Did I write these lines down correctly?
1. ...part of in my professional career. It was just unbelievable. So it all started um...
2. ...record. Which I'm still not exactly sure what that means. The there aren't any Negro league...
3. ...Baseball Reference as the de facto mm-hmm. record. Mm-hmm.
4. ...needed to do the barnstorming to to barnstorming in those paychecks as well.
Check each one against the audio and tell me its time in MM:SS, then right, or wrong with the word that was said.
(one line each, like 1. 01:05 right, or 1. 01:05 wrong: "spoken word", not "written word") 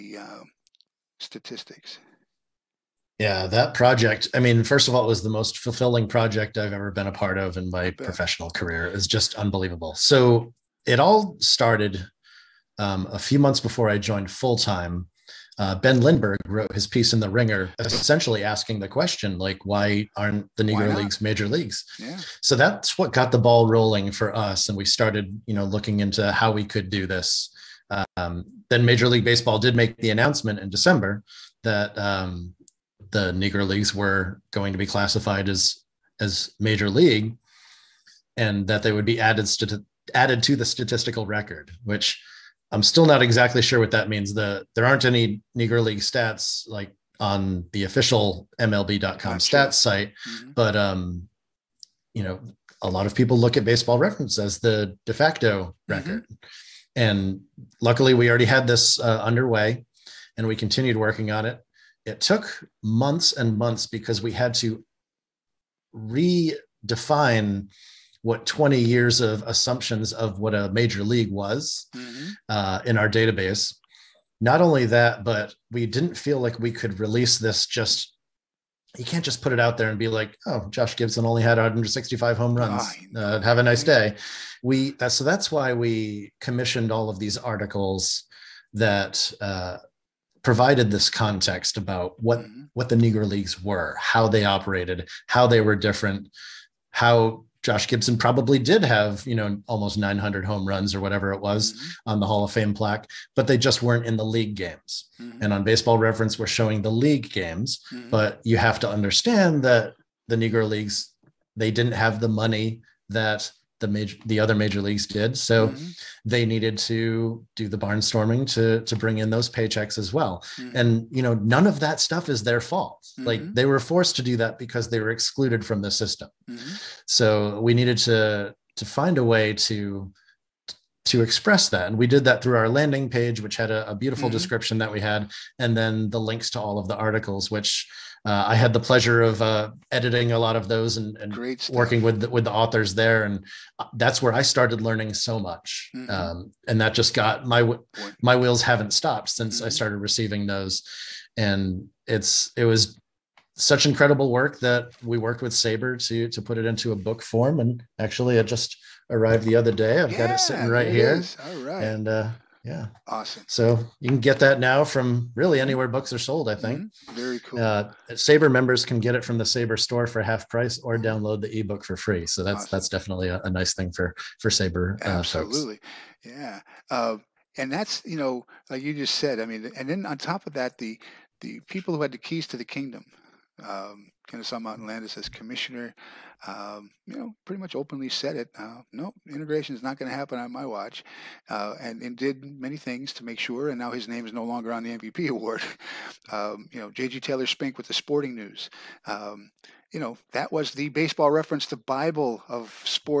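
1. 00:07 right
2. 00:41 right
3. 00:53 right
4. 01:56 wrong: "bring", not "barnstorming".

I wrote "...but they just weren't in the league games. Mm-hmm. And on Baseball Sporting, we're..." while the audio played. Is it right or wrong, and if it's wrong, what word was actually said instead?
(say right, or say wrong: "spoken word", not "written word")
wrong: "Reference", not "Sporting".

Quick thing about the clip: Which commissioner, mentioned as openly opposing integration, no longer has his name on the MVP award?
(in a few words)
Kennesaw Mountain Landis.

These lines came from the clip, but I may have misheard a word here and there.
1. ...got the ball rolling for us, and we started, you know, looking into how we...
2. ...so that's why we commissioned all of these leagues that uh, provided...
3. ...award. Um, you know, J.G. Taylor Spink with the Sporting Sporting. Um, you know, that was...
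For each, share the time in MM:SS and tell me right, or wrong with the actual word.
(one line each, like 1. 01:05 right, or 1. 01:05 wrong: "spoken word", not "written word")
1. 00:23 right
2. 01:25 wrong: "articles", not "leagues"
3. 03:15 wrong: "News", not "Sporting".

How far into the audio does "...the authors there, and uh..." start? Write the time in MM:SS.
02:22.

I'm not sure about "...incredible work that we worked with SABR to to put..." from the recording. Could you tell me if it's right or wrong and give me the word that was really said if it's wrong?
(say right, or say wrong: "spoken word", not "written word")
right.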